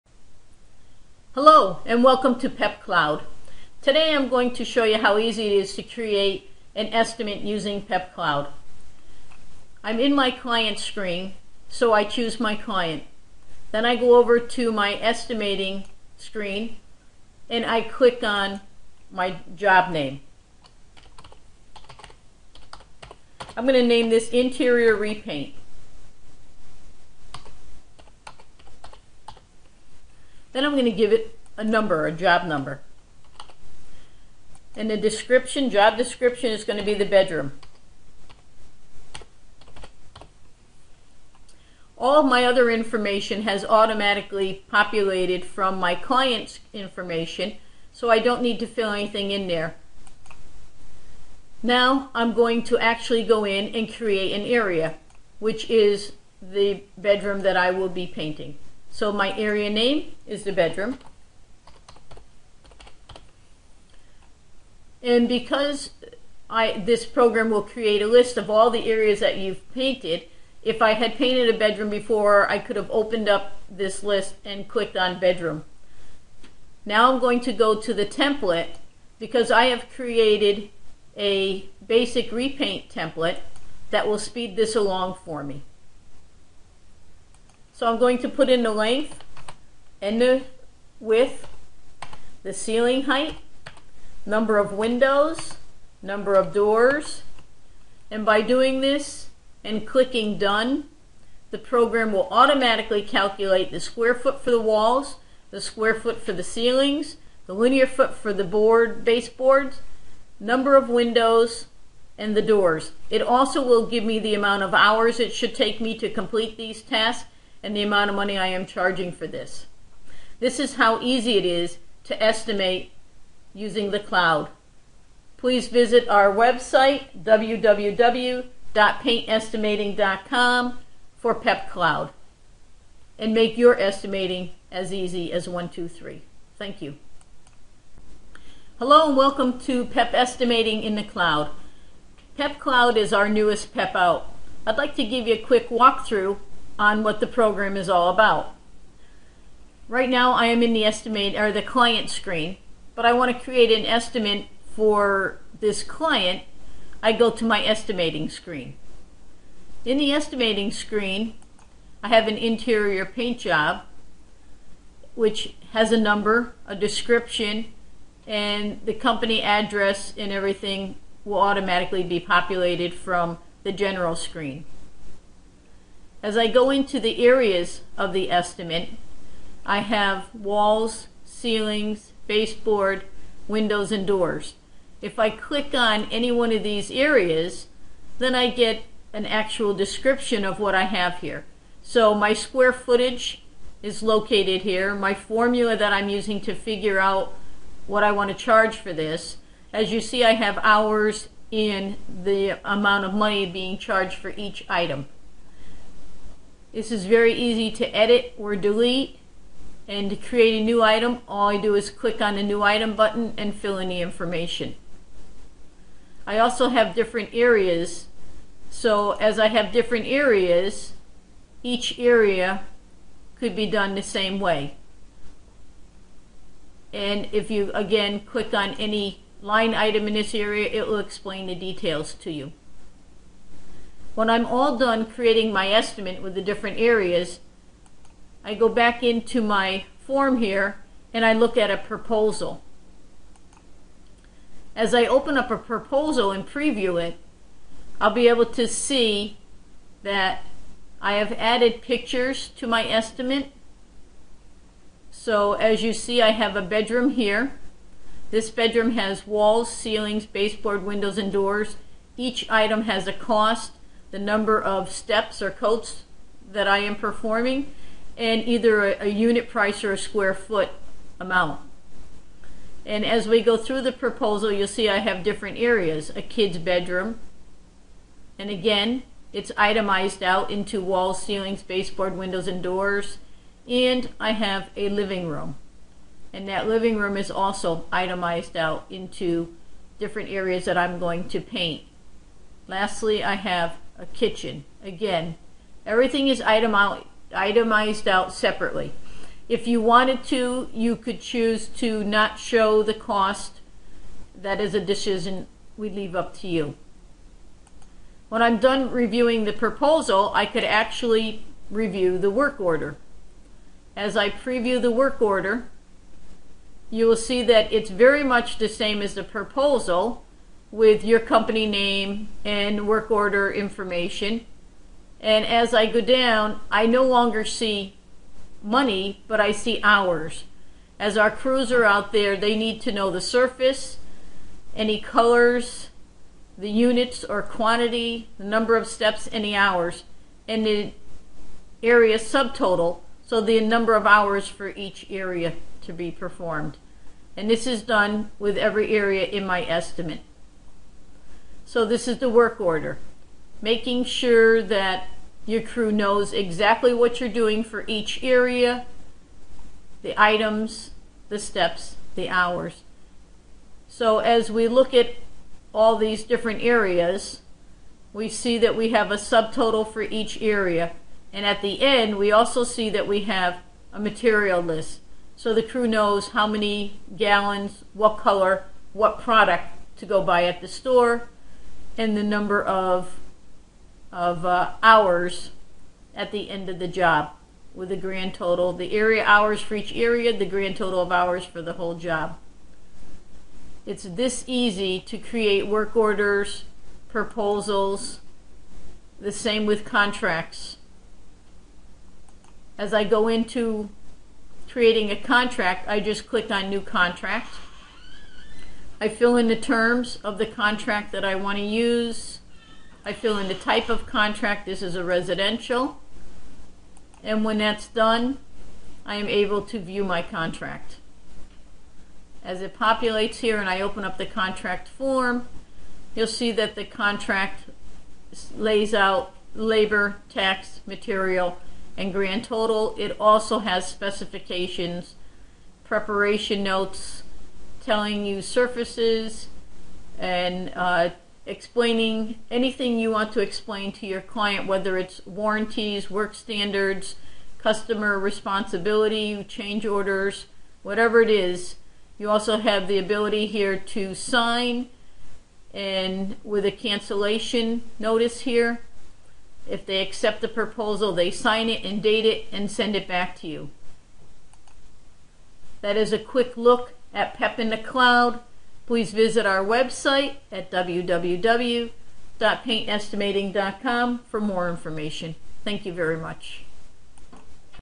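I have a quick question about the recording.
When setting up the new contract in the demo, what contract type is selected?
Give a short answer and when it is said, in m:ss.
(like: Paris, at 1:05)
Residential, at 6:55.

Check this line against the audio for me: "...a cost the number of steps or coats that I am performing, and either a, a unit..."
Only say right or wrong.
right.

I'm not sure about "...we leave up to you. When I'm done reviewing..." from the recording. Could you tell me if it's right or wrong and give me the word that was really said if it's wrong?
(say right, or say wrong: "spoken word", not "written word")
right.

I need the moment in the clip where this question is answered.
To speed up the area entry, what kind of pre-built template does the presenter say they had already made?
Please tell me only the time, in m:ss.
1:21.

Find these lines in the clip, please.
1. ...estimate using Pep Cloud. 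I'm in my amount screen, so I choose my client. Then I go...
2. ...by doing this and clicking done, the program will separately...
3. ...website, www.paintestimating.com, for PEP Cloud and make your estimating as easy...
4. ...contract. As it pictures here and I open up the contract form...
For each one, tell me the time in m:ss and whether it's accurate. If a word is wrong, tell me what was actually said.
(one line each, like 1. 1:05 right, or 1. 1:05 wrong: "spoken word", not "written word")
1. 0:06 wrong: "client", not "amount"
2. 1:38 wrong: "automatically", not "separately"
3. 2:06 right
4. 7:00 wrong: "populates", not "pictures".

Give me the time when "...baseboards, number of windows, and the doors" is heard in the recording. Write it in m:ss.
1:49.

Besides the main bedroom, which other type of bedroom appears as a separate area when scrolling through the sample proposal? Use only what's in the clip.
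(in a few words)
Kid's bedroom.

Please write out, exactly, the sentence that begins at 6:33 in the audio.
It's this easy to create work orders, proposals, the same with contracts.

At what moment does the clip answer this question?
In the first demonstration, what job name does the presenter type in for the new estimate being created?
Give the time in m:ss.
0:24.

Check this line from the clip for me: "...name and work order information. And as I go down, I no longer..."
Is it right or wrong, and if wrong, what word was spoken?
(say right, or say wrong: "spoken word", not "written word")
right.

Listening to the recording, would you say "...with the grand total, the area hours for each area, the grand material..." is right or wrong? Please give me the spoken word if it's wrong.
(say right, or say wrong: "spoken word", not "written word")
wrong: "total", not "material".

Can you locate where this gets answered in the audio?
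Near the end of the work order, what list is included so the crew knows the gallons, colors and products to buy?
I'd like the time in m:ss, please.
6:13.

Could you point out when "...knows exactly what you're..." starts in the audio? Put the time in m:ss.
5:55.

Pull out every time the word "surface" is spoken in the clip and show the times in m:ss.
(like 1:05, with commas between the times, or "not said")
5:33, 7:18.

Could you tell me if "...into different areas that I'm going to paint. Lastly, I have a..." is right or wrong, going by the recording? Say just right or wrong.
right.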